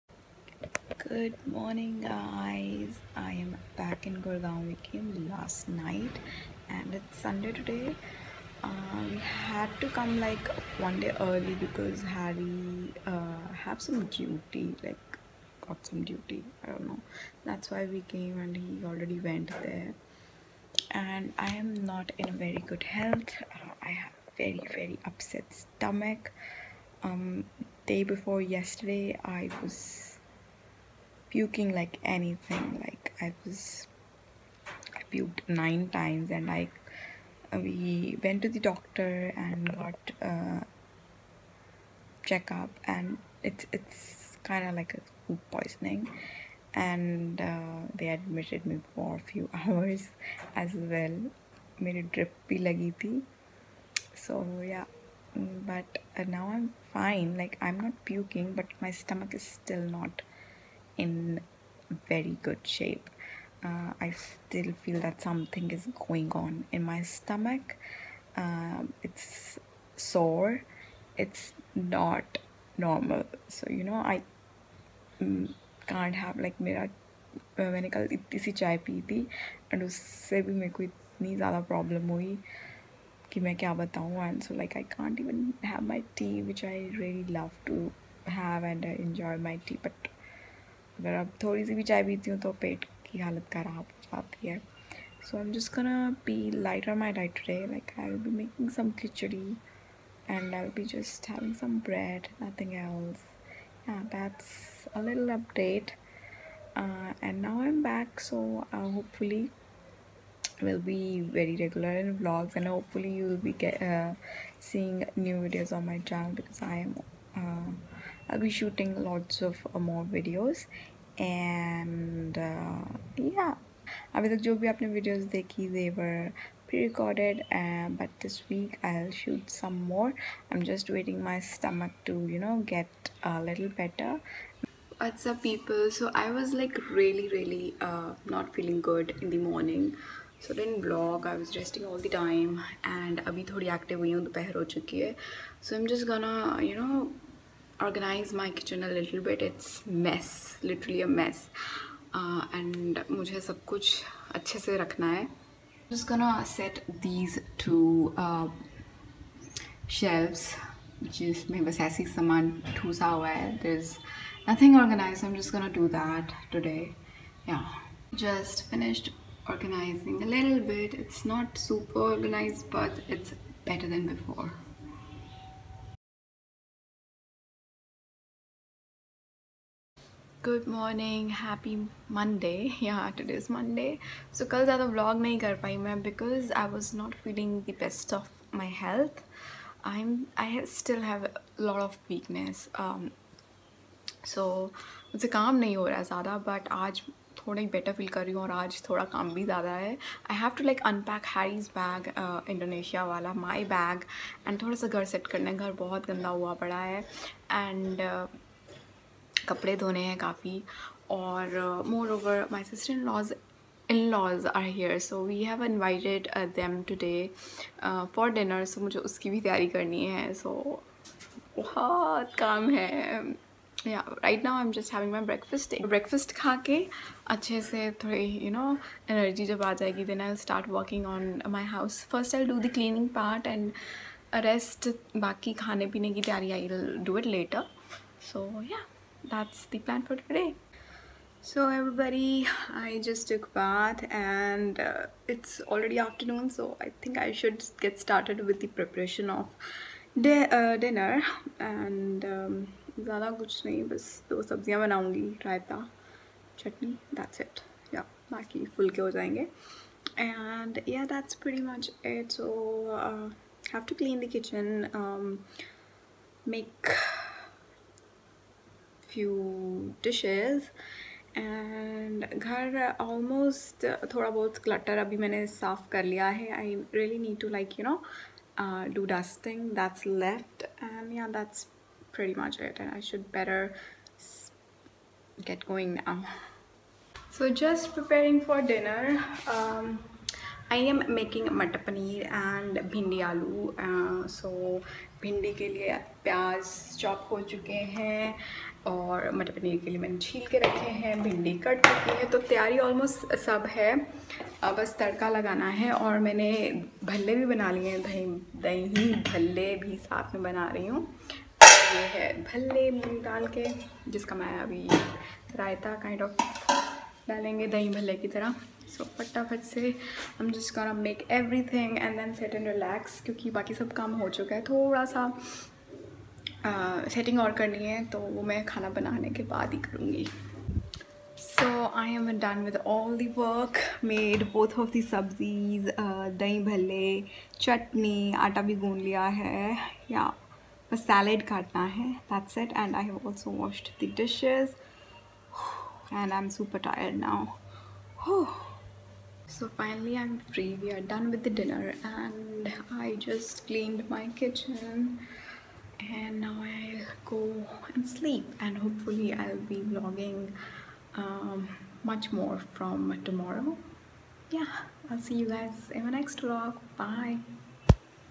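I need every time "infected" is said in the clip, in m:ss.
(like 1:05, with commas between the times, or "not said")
not said.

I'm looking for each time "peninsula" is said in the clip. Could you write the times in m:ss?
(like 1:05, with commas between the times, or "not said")
not said.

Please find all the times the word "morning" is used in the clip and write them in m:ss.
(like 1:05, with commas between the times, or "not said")
0:01, 2:19.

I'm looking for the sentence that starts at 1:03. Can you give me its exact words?
Uh, I still feel that something is going on in my stomach.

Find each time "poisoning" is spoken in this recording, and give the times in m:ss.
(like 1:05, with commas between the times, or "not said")
0:45.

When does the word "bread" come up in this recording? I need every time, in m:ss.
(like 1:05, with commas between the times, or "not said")
1:41.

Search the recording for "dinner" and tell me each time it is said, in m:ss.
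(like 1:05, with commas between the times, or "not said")
4:10, 4:48, 5:51.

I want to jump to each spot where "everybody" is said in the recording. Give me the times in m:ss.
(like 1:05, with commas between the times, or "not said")
4:01.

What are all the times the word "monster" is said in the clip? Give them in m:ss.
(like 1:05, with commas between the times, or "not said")
not said.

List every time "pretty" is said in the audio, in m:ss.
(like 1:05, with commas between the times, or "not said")
4:21, 4:42.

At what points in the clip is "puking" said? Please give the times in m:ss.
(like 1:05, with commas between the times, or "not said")
0:31, 0:58.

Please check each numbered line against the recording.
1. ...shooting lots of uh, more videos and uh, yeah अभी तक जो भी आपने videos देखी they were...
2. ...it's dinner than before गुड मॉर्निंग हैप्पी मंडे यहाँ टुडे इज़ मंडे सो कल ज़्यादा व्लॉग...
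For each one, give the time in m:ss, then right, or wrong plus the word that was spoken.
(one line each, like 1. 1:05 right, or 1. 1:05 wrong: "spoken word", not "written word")
1. 1:58 right
2. 2:53 wrong: "better", not "dinner".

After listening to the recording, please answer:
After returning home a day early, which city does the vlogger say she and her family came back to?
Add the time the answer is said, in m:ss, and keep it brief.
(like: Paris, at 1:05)
Gurgaon, at 0:04.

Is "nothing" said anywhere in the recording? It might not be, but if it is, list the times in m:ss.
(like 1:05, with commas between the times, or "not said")
1:42, 2:44.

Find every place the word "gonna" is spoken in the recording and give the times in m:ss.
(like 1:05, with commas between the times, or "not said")
1:35, 2:36, 2:45.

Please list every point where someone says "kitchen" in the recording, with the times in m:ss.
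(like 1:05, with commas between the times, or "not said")
2:28, 5:54.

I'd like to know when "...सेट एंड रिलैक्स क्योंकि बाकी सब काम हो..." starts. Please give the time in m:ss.
5:22.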